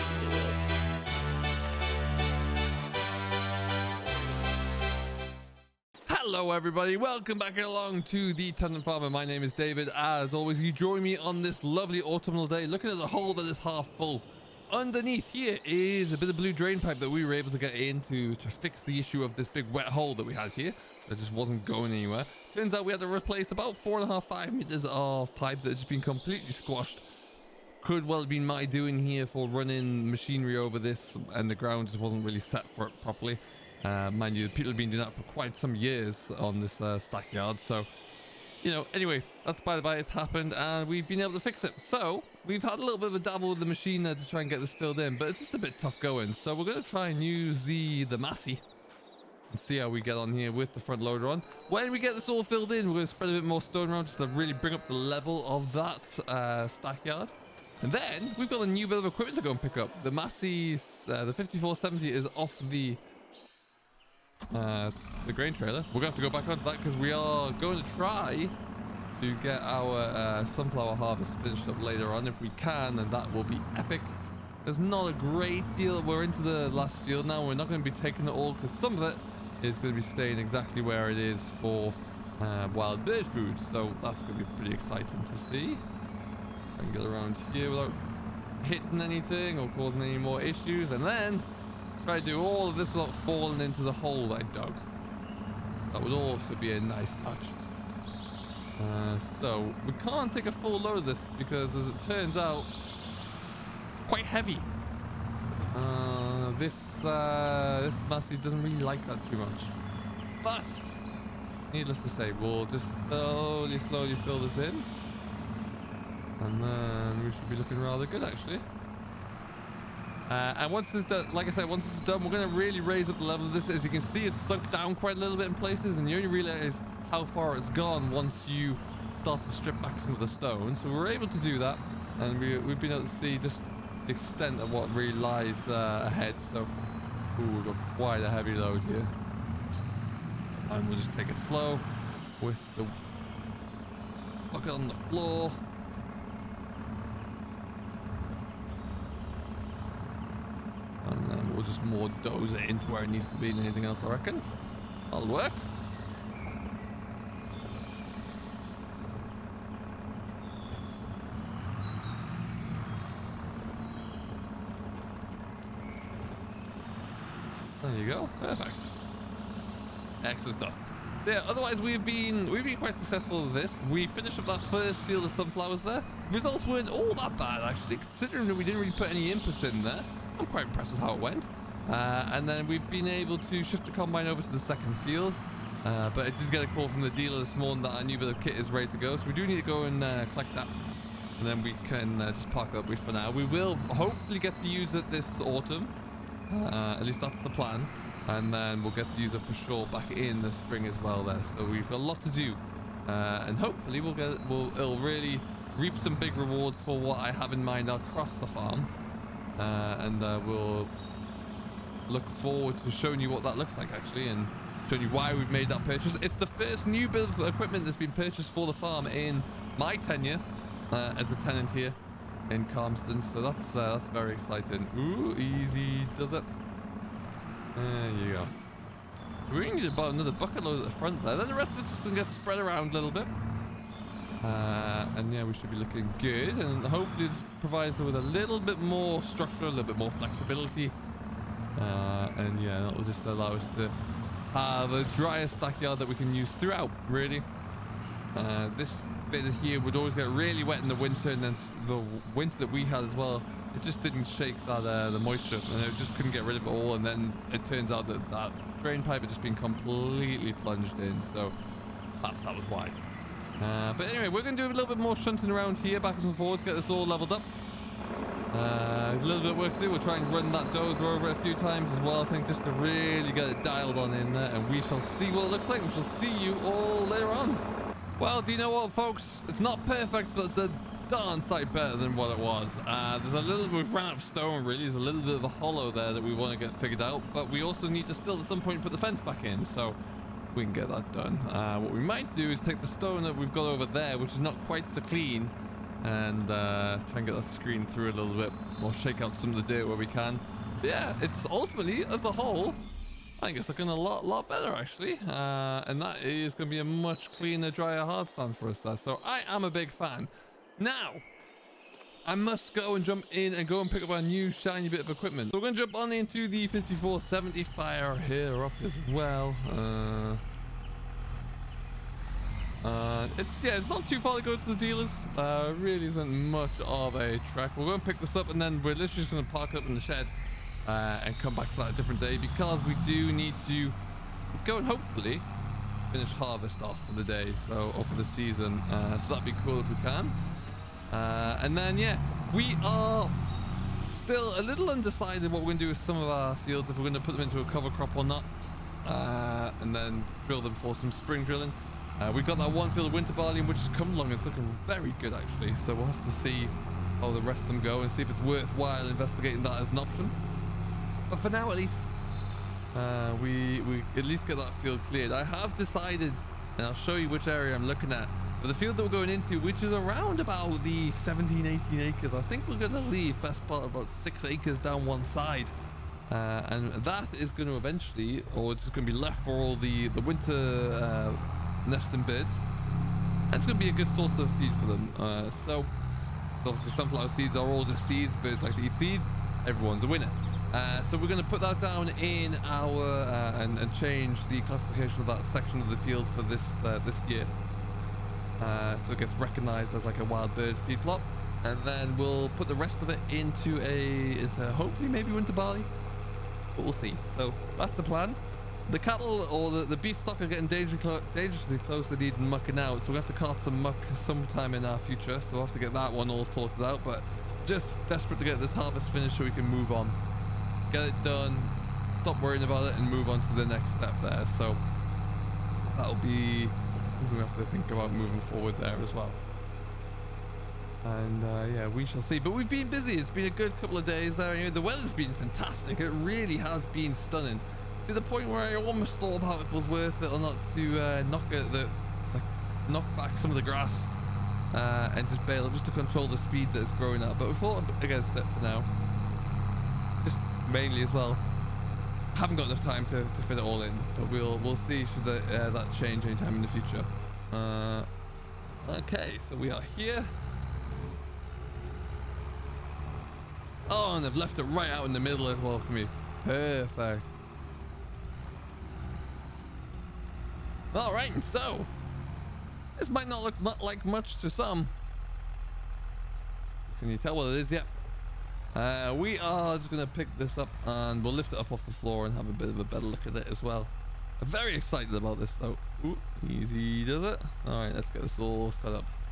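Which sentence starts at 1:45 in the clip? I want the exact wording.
Uh, this, uh, this Massey doesn't really like that too much.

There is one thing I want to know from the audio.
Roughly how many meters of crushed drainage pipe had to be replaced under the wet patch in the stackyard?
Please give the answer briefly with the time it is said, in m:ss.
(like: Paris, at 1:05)
4.5 to 5, at 0:23.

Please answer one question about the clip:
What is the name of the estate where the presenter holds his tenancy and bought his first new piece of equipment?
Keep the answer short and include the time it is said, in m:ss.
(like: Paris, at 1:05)
Calmsden, at 3:42.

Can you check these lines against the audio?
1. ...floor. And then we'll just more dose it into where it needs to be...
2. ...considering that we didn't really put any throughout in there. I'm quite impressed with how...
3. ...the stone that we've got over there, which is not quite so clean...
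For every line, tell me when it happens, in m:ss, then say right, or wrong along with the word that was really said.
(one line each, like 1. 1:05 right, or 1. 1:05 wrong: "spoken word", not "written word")
1. 2:25 right
2. 2:57 wrong: "input", not "throughout"
3. 4:52 right.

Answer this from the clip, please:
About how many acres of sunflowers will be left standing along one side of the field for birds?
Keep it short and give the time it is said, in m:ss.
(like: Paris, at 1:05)
6 acres, at 6:14.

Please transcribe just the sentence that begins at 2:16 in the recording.
So, ooh, we've got quite a heavy load here.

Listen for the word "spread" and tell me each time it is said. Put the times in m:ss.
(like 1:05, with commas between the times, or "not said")
0:53, 3:52.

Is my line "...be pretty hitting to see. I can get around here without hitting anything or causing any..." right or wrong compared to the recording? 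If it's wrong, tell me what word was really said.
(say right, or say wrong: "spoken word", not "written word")
wrong: "exciting", not "hitting".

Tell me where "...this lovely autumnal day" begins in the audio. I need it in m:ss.
0:11.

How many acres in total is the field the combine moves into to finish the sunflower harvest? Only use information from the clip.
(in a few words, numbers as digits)
17 to 18 acres.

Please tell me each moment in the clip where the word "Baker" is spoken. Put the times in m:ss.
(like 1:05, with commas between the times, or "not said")
not said.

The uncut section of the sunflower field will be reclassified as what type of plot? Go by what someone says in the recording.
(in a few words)
Wild bird feed plot.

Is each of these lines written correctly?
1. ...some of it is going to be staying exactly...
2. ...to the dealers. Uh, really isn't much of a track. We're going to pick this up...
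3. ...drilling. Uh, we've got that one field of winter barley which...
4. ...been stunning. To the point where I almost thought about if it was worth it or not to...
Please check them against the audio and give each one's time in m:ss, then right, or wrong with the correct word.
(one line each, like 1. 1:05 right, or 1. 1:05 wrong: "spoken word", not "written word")
1. 1:18 right
2. 5:24 right
3. 5:51 right
4. 7:16 right.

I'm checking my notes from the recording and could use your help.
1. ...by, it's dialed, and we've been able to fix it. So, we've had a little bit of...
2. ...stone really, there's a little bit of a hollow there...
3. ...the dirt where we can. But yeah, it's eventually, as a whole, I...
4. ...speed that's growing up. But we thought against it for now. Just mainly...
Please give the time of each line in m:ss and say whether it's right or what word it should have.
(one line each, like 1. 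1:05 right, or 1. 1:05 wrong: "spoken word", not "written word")
1. 0:39 wrong: "happened", not "dialed"
2. 4:44 right
3. 4:59 wrong: "ultimately", not "eventually"
4. 7:26 right.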